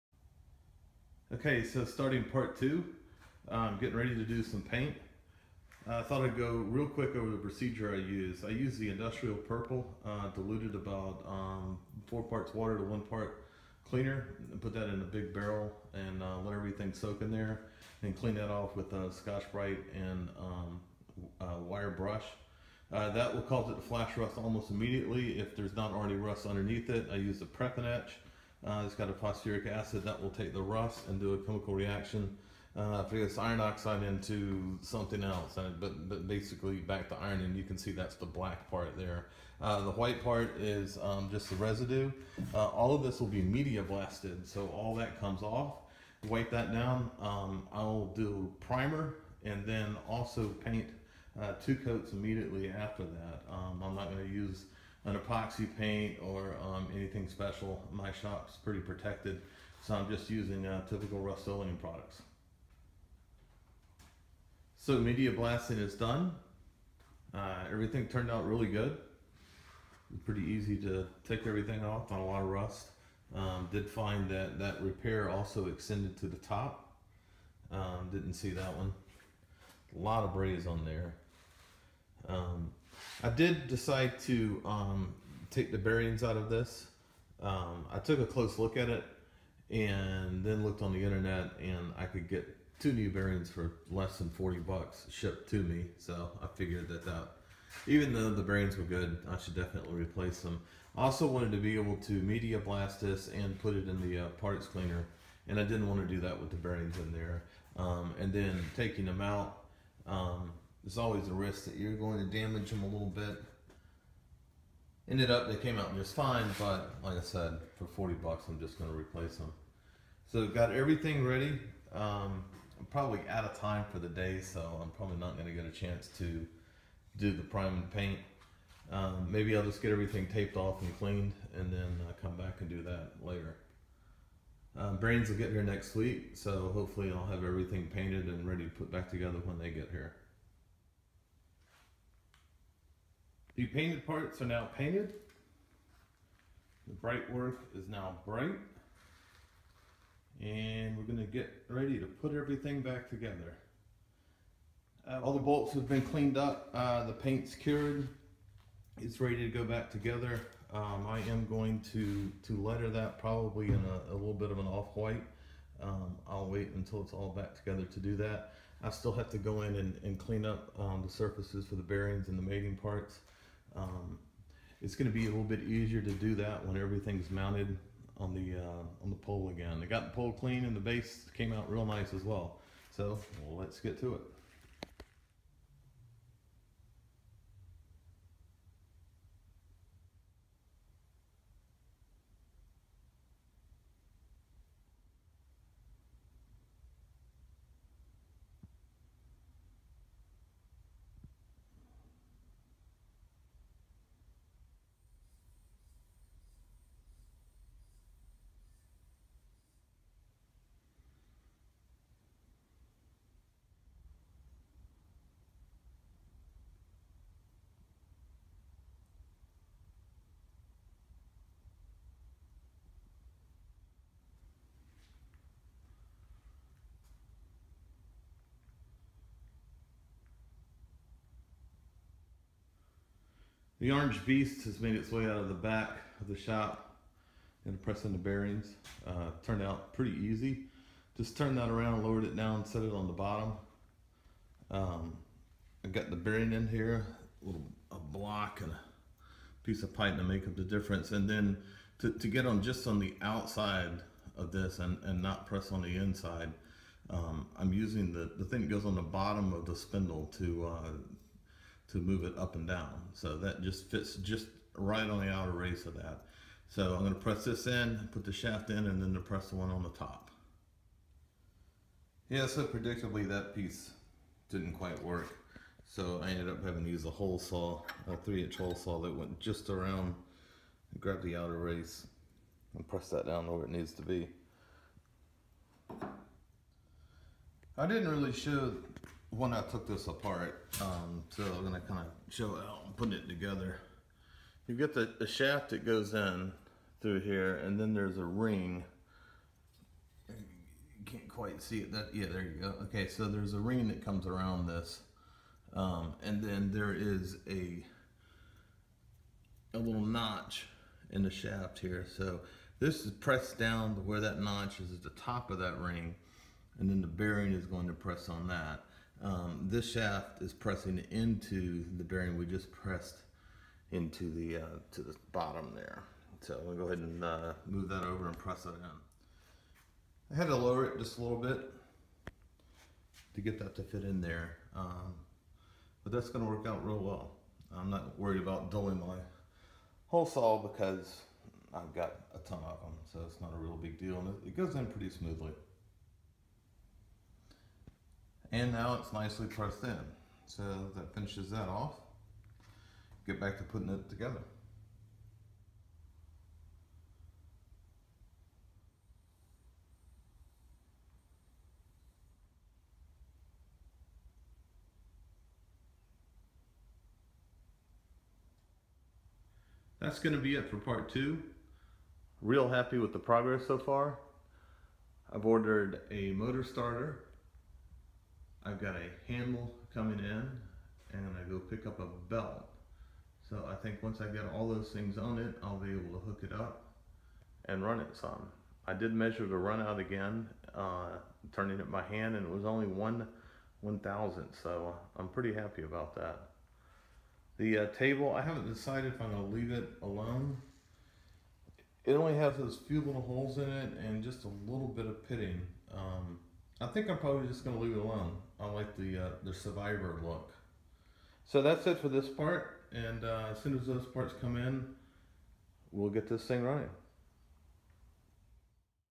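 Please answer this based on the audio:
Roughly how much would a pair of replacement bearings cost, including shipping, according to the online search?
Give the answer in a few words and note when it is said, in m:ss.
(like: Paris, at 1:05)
less than $40, at 1:33.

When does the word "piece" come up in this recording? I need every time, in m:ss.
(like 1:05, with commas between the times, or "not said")
4:09, 4:33.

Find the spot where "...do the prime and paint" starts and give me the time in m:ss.
2:07.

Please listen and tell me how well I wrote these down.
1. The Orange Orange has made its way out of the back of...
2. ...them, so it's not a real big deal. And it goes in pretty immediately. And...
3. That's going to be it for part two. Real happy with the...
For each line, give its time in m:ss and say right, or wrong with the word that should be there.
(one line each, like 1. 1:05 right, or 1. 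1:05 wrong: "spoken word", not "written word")
1. 3:53 wrong: "Beast", not "Orange"
2. 5:42 wrong: "smoothly", not "immediately"
3. 6:10 right.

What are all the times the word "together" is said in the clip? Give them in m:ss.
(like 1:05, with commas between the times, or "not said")
2:19, 2:33, 2:39, 2:47, 4:53, 5:54.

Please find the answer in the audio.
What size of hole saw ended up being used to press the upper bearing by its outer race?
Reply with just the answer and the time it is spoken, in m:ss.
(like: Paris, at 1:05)
3 inch, at 4:38.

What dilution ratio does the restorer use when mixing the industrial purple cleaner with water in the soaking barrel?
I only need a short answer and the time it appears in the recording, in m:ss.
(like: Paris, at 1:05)
4 parts water to 1 part cleaner, at 0:12.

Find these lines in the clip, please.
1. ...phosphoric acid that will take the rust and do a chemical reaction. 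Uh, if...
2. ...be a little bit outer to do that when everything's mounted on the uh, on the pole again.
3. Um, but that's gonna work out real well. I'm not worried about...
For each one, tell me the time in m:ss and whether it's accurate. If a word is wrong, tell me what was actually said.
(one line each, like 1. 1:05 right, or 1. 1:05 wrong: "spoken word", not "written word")
1. 0:29 right
2. 2:55 wrong: "easier", not "outer"
3. 5:34 right.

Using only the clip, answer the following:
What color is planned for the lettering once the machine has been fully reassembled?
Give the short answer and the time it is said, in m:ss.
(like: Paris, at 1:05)
off-white, at 2:44.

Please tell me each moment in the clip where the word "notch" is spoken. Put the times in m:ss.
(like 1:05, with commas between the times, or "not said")
5:10, 5:14.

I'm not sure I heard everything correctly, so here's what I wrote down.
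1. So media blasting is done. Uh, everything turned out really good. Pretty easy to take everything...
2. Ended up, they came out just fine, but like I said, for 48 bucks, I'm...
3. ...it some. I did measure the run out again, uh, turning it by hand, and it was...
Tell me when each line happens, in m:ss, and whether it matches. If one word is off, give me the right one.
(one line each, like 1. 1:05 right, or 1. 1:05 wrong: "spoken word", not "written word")
1. 1:04 right
2. 1:55 wrong: "40", not "48"
3. 6:27 right.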